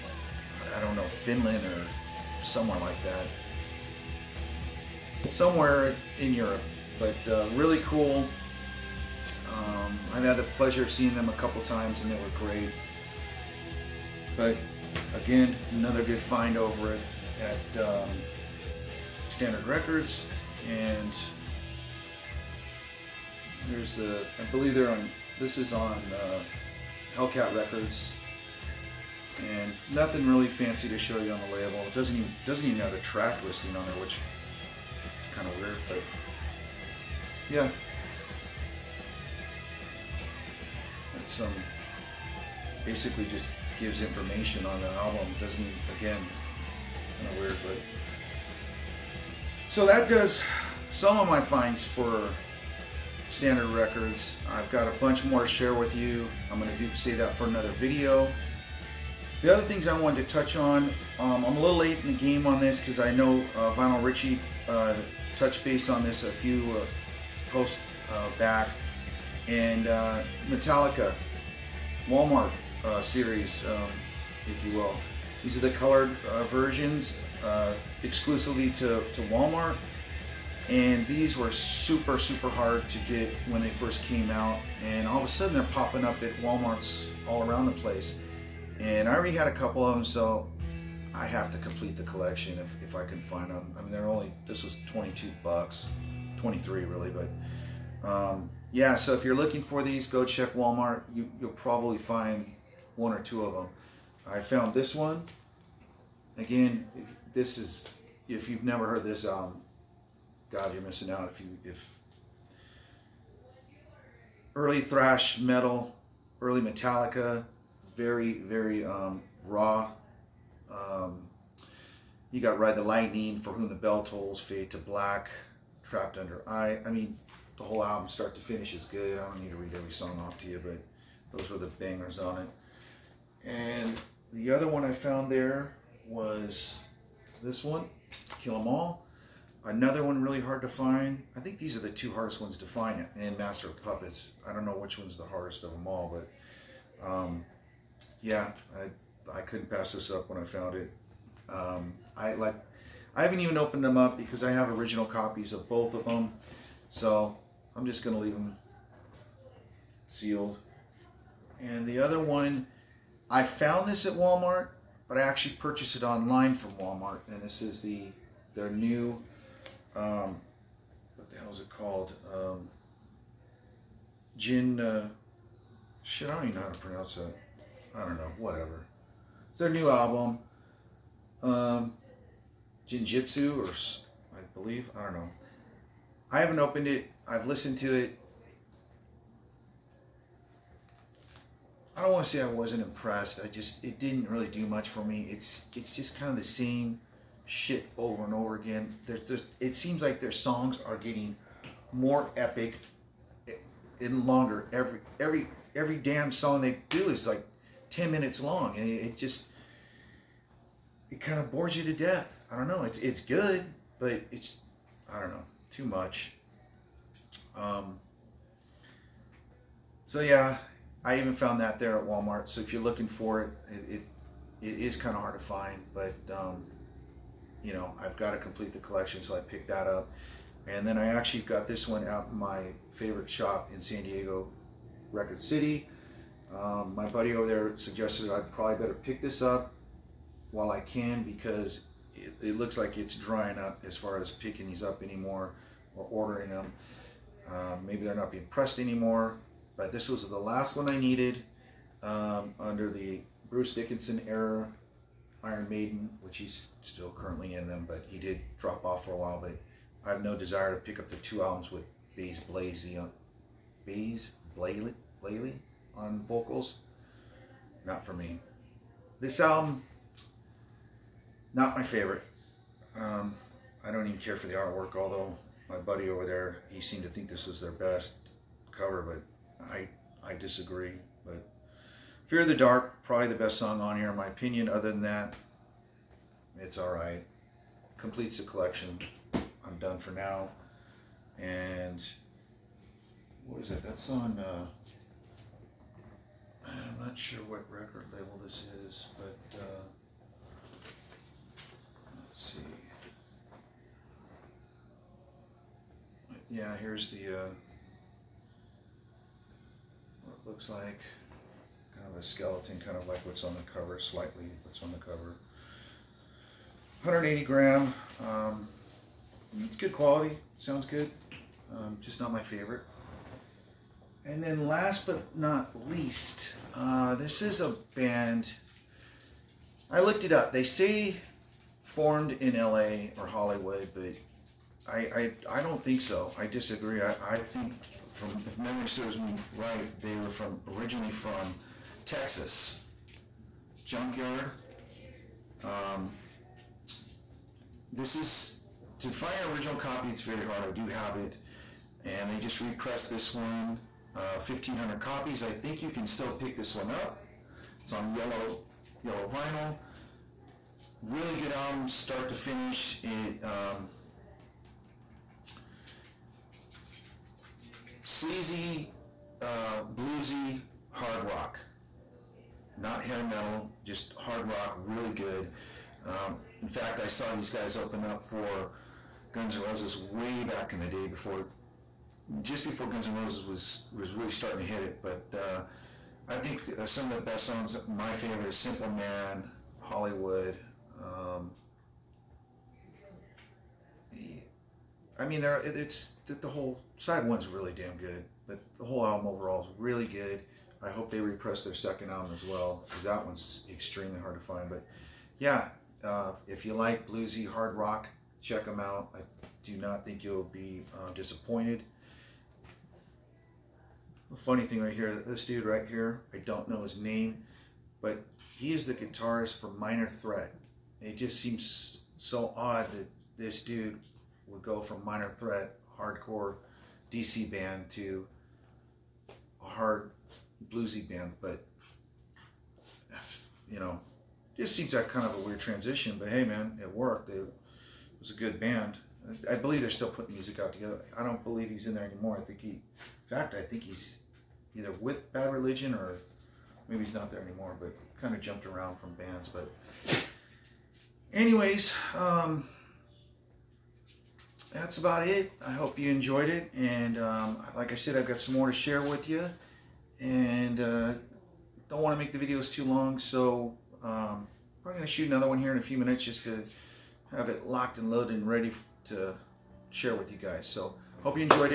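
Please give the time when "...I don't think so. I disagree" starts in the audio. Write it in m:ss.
5:35.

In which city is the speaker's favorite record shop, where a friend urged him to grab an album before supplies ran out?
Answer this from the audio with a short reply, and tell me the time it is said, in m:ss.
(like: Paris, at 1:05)
San Diego, at 3:53.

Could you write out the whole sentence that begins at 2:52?
Um, gin, uh, shit, I don't even know how to pronounce that.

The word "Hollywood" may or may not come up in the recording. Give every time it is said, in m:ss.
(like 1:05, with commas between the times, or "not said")
5:33, 6:29.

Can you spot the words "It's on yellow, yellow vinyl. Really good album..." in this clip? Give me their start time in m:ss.
5:57.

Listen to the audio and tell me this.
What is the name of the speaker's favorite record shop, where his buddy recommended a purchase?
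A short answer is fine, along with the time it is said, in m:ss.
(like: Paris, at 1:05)
Record City, at 3:55.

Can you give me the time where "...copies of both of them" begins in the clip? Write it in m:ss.
2:35.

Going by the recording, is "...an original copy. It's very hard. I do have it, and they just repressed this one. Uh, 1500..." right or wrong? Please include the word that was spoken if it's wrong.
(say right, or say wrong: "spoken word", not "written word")
right.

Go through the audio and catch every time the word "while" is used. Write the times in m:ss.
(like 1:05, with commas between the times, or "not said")
4:00, 4:19.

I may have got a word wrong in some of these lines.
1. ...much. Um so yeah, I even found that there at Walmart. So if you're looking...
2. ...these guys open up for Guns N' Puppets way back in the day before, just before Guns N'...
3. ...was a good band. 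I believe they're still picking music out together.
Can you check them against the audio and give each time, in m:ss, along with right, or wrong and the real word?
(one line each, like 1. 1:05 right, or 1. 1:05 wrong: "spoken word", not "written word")
1. 3:35 right
2. 6:17 wrong: "Roses", not "Puppets"
3. 7:18 wrong: "putting", not "picking".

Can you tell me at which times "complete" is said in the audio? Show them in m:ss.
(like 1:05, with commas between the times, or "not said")
1:31, 3:48, 4:47.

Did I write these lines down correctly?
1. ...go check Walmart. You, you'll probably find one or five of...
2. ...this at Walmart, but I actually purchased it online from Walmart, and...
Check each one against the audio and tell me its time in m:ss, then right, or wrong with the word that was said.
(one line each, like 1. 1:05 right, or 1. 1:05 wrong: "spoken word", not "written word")
1. 1:40 wrong: "two", not "five"
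2. 2:43 right.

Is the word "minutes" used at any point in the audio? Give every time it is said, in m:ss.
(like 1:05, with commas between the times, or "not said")
3:28, 7:45.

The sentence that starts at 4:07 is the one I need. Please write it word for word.
Um, maybe they're not being pressed anymore.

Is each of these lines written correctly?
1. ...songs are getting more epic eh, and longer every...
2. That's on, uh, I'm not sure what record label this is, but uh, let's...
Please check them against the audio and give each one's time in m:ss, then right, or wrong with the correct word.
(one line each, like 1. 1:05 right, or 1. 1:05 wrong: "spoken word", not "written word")
1. 3:20 right
2. 4:53 right.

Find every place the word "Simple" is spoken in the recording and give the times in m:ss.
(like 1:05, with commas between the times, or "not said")
6:28.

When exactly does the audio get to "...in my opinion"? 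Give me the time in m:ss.
4:44.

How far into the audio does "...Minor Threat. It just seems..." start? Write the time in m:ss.
6:59.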